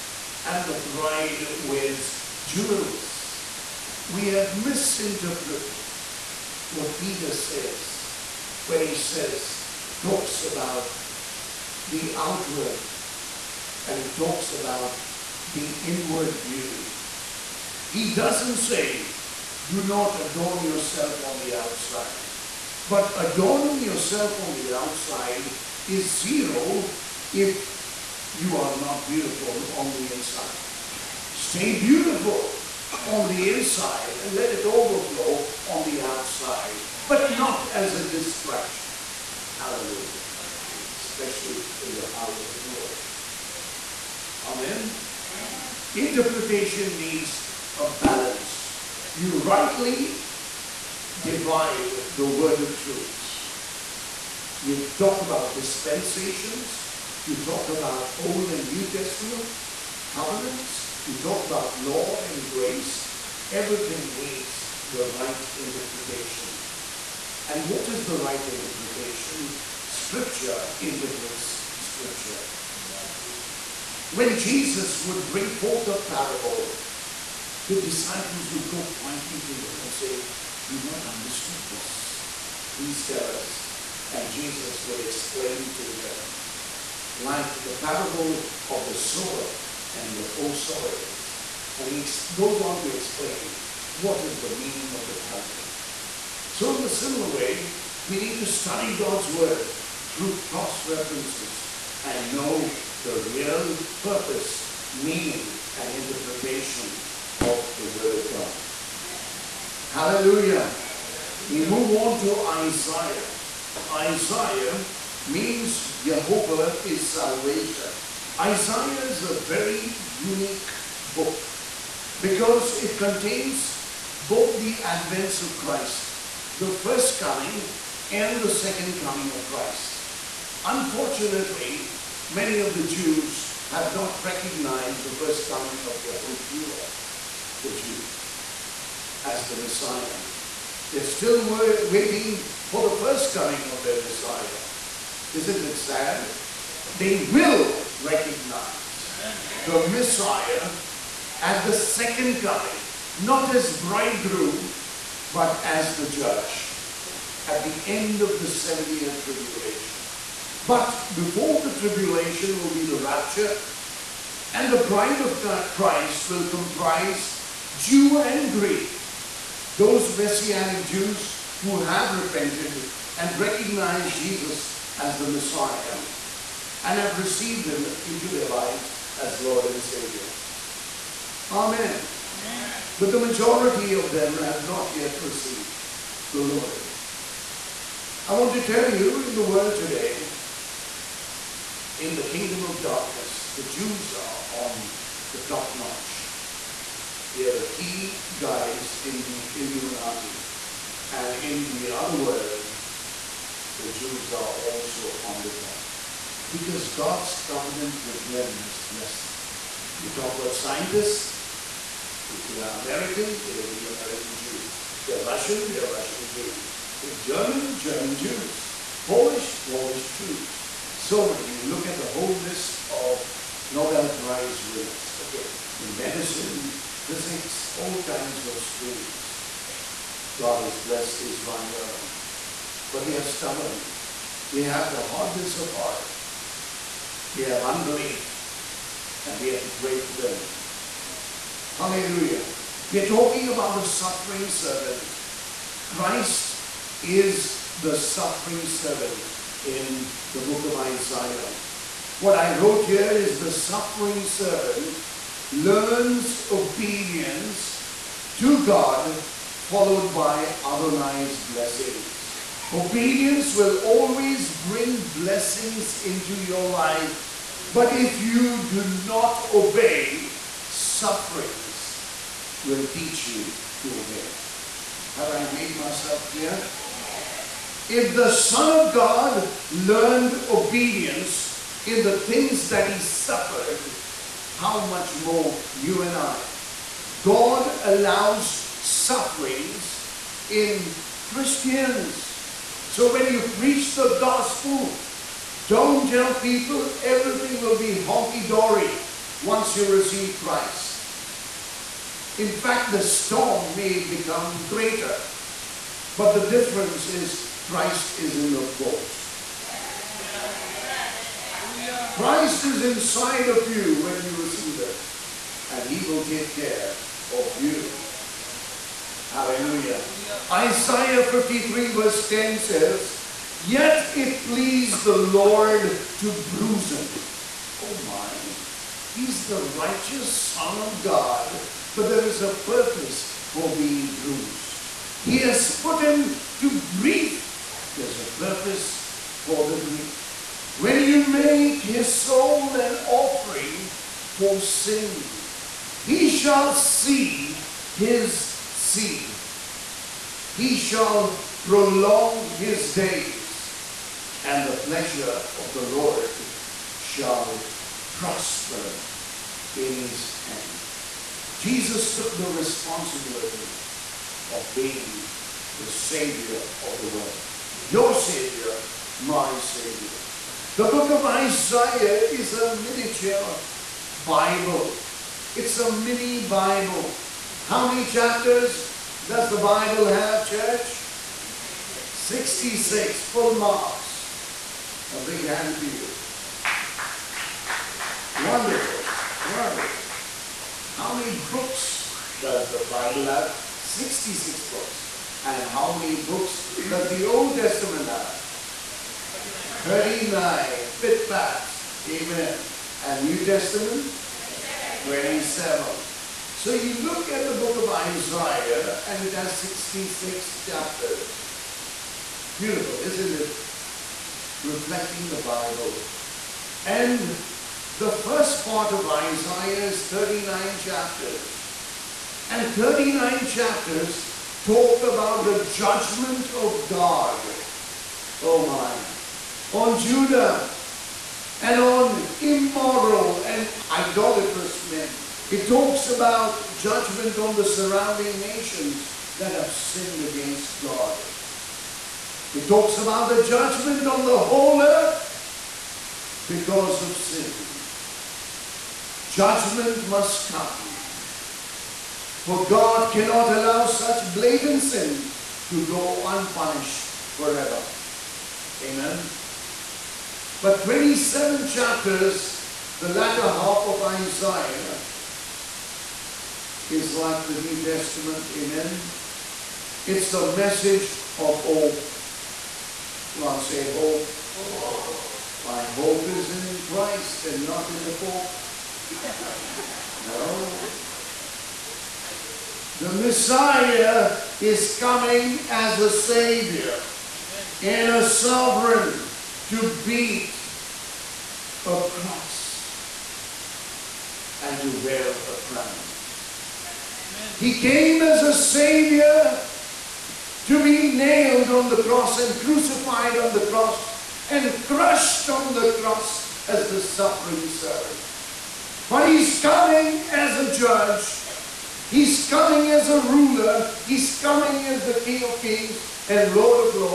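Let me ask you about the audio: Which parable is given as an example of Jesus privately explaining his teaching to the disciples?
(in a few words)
the sower and the four soils.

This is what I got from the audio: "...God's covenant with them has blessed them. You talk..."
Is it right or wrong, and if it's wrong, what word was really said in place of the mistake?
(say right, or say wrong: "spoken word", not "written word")
right.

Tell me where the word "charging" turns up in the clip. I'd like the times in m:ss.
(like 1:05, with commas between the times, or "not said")
not said.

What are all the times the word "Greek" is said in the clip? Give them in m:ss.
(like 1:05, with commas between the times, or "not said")
2:48.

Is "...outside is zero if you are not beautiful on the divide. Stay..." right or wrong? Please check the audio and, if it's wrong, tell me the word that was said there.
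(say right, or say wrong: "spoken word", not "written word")
wrong: "inside", not "divide".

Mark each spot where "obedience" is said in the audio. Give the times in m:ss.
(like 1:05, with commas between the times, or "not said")
4:16, 4:22, 4:40.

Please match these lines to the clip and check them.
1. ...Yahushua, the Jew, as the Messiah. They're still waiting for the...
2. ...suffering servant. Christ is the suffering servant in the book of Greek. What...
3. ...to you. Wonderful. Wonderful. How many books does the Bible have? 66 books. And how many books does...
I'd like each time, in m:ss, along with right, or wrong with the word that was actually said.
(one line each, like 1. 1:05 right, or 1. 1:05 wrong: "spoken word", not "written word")
1. 2:16 right
2. 4:03 wrong: "Isaiah", not "Greek"
3. 6:25 right.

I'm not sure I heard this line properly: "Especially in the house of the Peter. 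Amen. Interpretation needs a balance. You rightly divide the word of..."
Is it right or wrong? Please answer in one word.
wrong.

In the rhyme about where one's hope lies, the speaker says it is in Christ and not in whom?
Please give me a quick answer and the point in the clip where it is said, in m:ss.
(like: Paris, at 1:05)
the Pope, at 7:58.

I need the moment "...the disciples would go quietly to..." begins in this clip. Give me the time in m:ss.
1:17.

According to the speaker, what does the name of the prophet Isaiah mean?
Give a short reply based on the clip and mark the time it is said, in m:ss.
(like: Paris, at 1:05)
Jehovah is salvation, at 1:56.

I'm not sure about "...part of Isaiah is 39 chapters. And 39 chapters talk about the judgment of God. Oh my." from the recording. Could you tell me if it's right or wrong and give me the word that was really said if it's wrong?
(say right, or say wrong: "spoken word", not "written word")
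right.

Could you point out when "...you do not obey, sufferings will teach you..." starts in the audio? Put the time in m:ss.
4:28.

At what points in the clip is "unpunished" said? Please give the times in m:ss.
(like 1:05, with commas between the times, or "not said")
7:36.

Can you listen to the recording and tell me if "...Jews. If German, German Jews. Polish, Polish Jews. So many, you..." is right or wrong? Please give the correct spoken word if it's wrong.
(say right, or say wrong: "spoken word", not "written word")
right.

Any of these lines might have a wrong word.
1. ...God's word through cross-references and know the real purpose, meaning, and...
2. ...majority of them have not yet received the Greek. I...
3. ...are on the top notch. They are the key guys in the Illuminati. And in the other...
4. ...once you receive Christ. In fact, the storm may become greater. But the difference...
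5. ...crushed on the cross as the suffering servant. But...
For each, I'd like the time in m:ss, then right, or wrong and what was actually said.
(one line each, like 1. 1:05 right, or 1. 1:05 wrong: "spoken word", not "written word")
1. 1:38 right
2. 3:03 wrong: "Lord", not "Greek"
3. 3:14 right
4. 4:59 right
5. 8:24 right.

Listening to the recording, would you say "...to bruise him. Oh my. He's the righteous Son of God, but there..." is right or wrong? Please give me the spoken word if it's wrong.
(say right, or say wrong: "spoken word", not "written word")
right.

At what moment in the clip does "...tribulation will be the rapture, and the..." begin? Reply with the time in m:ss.
2:41.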